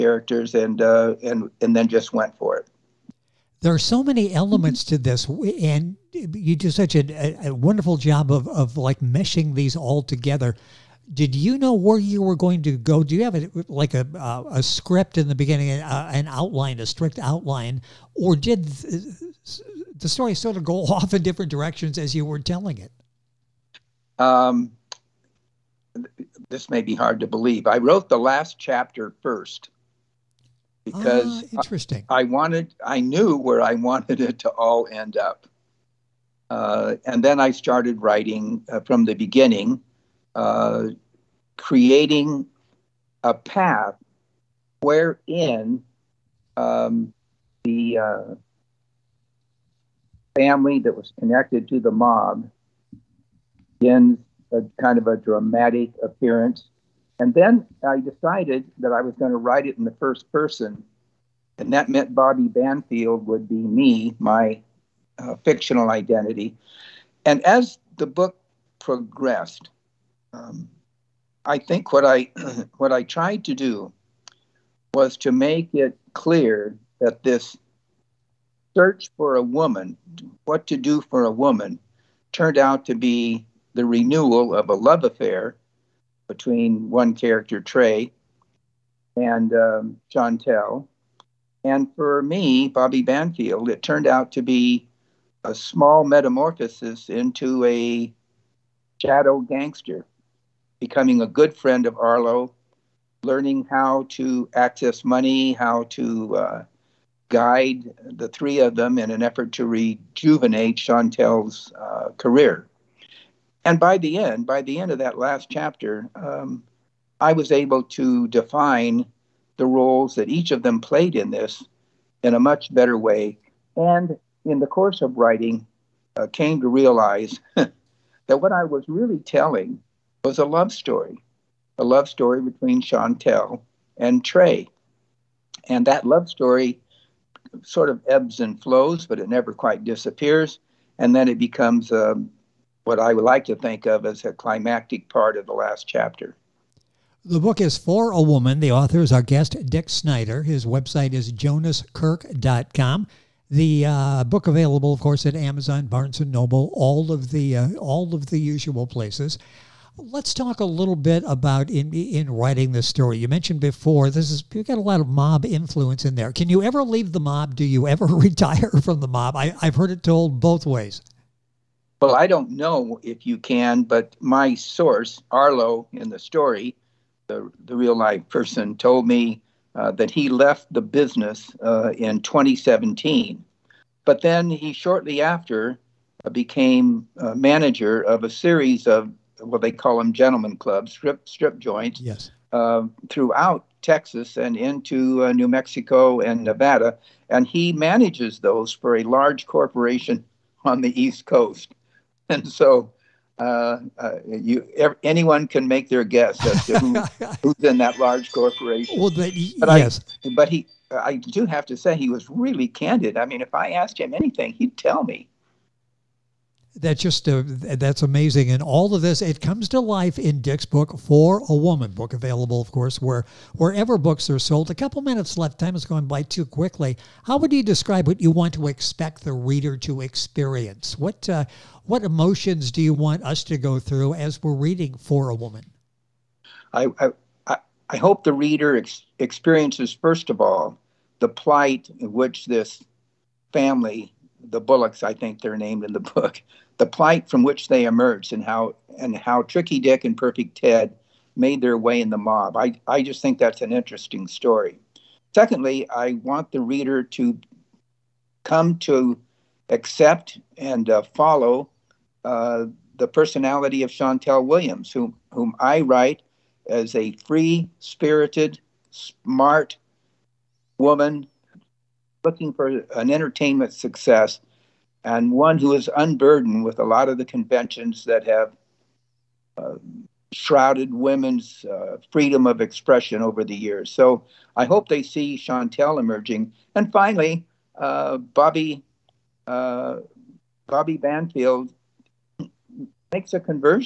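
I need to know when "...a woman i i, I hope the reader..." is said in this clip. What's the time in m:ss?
3:55.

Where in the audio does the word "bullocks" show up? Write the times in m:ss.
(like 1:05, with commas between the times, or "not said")
4:04.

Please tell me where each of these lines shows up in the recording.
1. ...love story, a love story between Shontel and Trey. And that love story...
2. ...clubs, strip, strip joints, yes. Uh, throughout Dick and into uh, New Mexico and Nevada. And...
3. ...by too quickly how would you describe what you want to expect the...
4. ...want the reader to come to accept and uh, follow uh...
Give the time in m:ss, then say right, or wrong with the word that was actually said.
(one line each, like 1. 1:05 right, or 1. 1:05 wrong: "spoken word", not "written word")
1. 2:10 right
2. 3:10 wrong: "Texas", not "Dick"
3. 3:46 right
4. 4:16 right.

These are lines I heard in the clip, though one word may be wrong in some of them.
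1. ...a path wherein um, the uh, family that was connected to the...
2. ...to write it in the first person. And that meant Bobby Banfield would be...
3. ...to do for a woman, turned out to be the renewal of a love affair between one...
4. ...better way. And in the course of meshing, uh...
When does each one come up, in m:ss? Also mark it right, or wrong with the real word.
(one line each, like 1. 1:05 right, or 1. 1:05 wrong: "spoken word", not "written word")
1. 0:43 right
2. 0:59 right
3. 1:20 right
4. 2:02 wrong: "writing", not "meshing".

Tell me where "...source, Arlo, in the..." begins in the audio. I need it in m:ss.
2:54.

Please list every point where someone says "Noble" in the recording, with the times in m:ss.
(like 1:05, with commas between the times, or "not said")
2:36.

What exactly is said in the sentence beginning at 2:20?
And then it becomes a um, what I would like to think of as a climactic part of the last chapter.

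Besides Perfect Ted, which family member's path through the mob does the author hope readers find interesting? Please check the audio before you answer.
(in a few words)
Tricky Dick.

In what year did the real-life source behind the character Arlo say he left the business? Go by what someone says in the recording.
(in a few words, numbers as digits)
2017.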